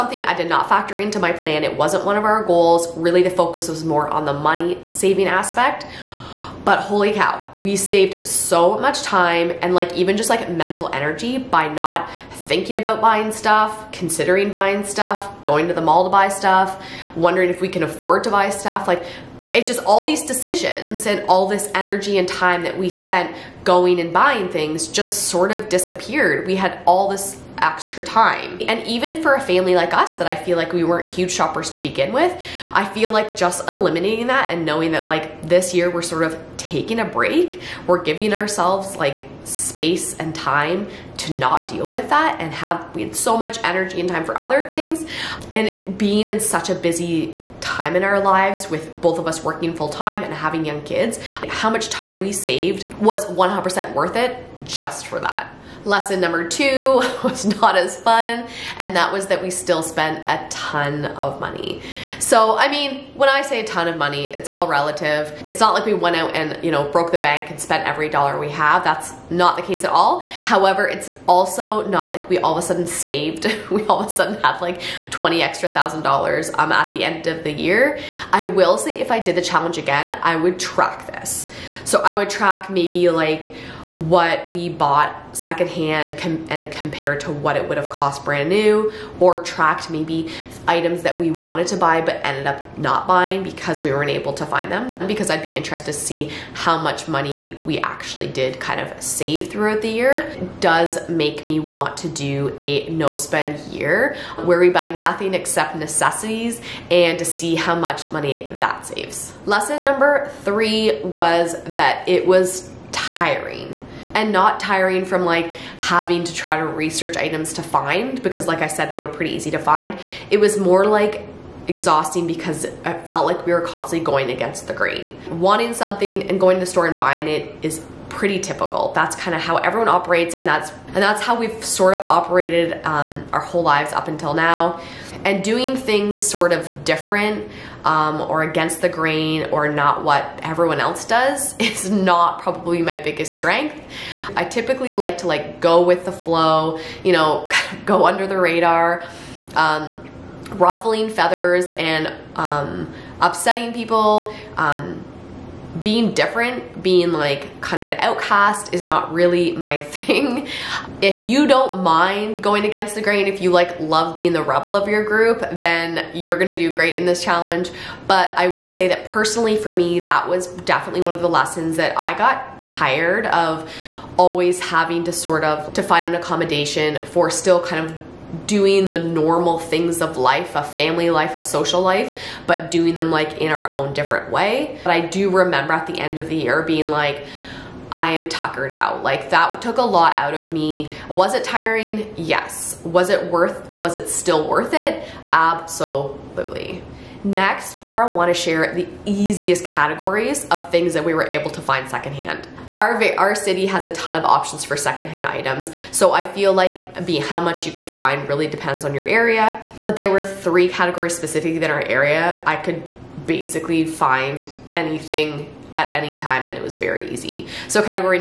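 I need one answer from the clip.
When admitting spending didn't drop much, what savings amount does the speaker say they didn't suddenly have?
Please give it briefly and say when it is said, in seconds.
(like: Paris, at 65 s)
$20,000, at 75 s.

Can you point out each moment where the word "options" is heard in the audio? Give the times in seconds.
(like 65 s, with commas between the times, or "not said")
204 s.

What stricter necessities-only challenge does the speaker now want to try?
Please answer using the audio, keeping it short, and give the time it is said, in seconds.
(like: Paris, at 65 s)
no spend year, at 102 s.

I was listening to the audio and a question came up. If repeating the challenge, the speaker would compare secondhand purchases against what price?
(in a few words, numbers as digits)
brand new.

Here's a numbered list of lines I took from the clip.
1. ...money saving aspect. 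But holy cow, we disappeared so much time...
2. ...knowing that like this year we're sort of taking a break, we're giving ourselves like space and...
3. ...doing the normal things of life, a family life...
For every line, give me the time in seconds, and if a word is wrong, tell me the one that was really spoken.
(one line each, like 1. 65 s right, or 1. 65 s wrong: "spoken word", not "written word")
1. 4 s wrong: "saved", not "disappeared"
2. 34 s right
3. 178 s right.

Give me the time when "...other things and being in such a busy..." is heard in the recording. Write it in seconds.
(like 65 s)
44 s.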